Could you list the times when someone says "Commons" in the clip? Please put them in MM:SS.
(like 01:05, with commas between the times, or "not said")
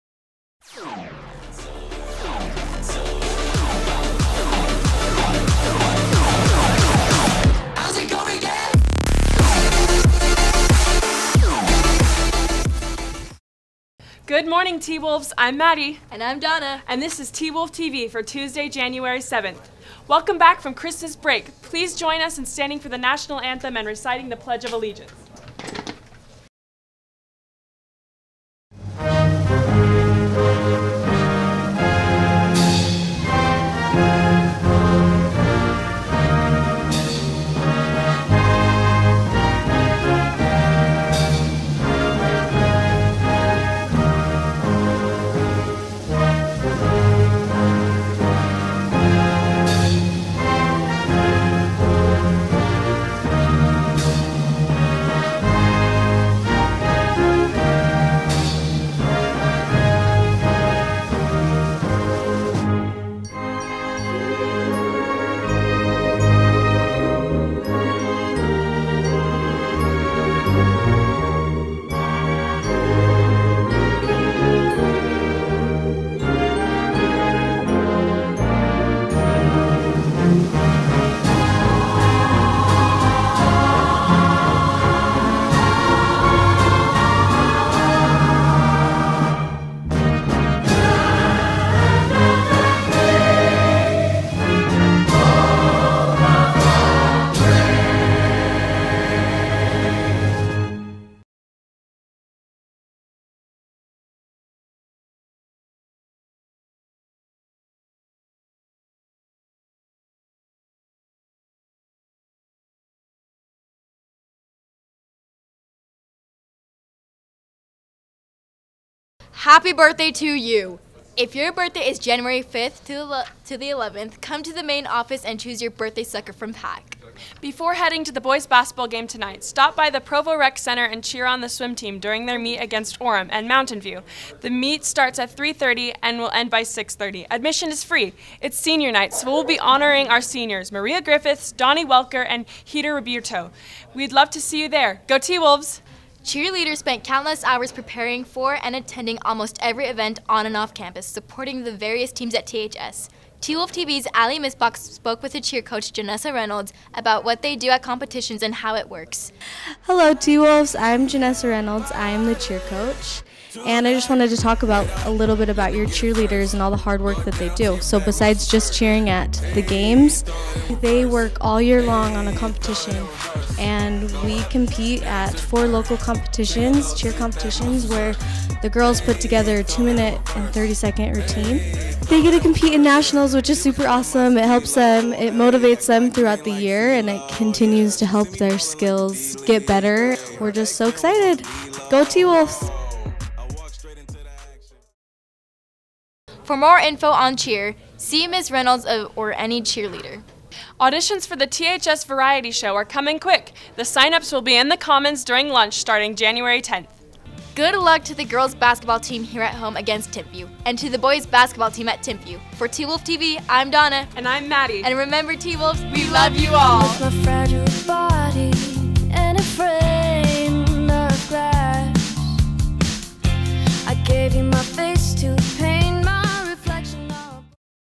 03:24.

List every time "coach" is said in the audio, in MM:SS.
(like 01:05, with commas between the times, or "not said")
02:35, 02:42.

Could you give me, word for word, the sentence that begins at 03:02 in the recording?
They get to compete in nationals, which is super awesome.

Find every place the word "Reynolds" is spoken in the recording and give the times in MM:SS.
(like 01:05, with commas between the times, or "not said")
02:36, 02:41, 03:18.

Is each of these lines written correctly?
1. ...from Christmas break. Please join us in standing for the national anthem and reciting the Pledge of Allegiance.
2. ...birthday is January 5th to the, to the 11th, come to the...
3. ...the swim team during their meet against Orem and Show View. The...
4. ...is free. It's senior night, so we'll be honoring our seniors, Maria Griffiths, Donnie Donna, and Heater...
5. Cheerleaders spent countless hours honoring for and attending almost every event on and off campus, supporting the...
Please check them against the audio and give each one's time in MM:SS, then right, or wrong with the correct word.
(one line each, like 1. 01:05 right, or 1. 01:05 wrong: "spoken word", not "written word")
1. 00:20 right
2. 02:01 right
3. 02:11 wrong: "Mountain", not "Show"
4. 02:17 wrong: "Welker", not "Donna"
5. 02:26 wrong: "preparing", not "honoring".